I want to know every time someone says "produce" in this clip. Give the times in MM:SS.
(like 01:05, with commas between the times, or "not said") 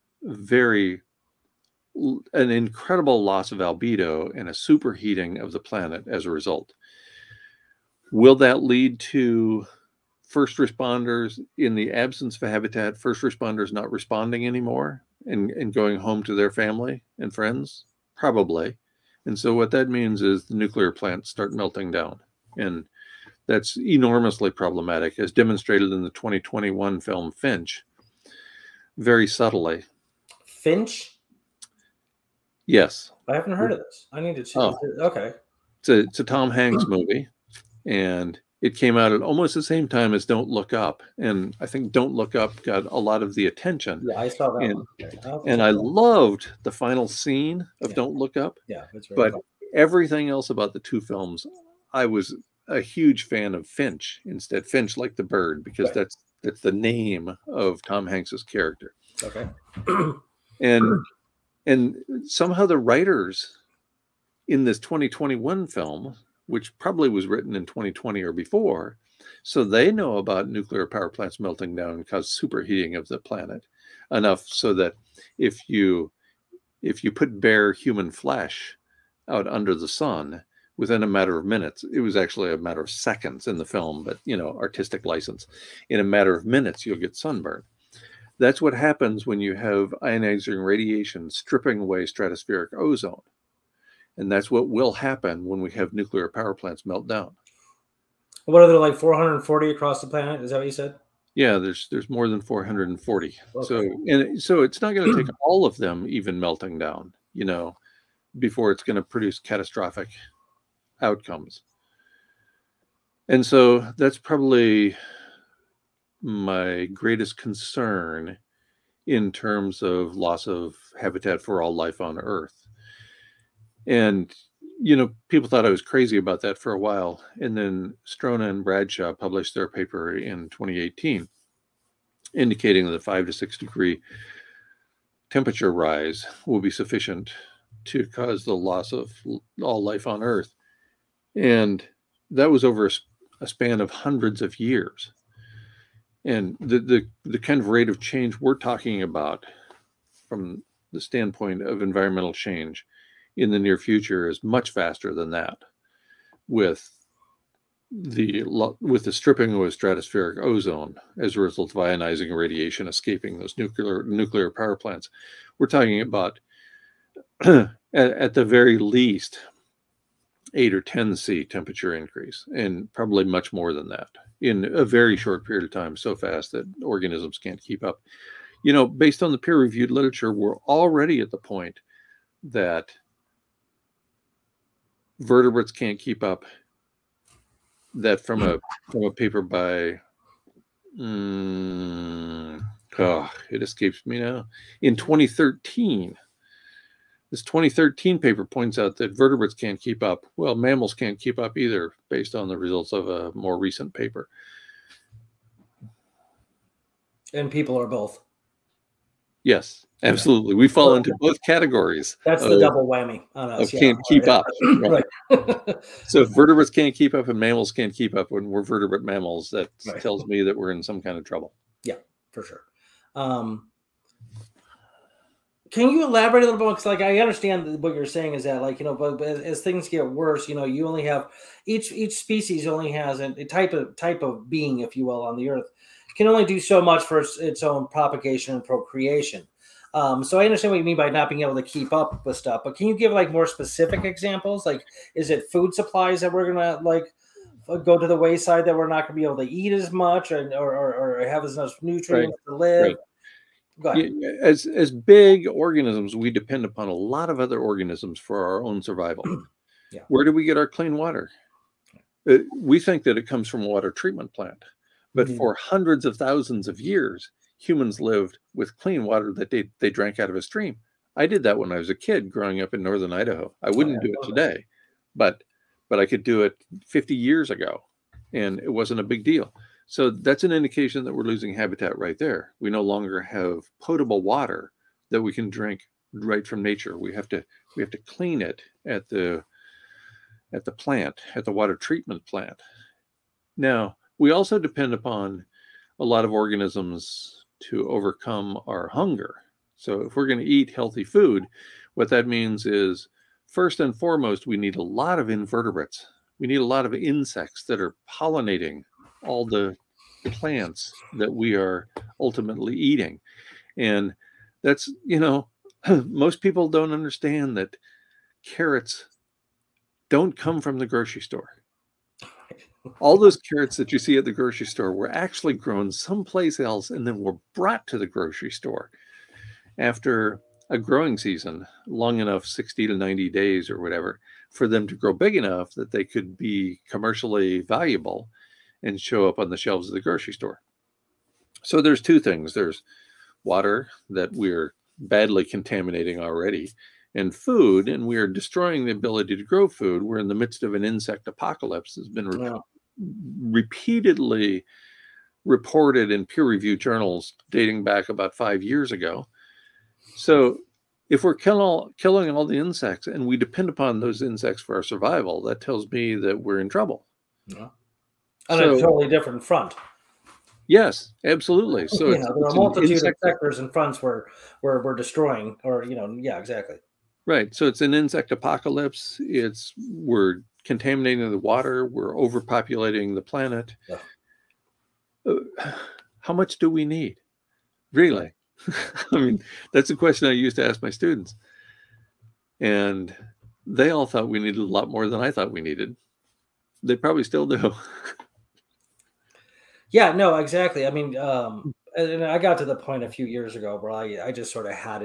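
01:49.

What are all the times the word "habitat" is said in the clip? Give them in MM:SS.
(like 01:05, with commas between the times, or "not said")
00:12, 02:01, 04:41.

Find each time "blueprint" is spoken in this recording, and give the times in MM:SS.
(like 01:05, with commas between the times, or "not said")
not said.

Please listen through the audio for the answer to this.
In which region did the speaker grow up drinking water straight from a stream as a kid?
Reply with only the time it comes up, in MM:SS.
04:32.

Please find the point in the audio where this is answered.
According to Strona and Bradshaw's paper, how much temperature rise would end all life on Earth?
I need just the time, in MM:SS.
02:12.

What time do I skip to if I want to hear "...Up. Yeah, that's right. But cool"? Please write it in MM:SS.
00:48.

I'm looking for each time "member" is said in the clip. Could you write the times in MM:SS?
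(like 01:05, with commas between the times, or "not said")
not said.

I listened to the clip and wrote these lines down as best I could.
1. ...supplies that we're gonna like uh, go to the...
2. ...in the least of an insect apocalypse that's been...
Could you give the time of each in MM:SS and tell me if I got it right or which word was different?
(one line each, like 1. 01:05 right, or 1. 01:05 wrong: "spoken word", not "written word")
1. 04:05 right
2. 05:50 wrong: "midst", not "least".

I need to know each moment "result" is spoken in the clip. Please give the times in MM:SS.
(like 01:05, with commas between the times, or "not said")
00:06, 02:41, 03:22.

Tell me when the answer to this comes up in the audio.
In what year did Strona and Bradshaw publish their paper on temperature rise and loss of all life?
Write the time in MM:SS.
02:10.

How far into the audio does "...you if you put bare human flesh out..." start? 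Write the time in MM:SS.
01:15.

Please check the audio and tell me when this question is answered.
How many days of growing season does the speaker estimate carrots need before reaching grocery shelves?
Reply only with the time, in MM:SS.
05:32.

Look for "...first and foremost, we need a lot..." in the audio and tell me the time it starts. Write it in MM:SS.
05:03.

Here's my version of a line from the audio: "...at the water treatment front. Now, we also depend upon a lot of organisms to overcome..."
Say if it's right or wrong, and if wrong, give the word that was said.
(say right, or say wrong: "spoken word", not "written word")
wrong: "plant", not "front".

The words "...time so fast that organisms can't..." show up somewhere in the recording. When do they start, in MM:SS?
02:55.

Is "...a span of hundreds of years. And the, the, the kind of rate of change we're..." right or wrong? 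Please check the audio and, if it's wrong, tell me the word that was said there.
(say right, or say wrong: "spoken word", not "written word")
right.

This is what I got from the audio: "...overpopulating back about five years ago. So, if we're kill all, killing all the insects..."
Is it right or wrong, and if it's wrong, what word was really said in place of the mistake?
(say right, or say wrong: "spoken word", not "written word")
wrong: "dating", not "overpopulating".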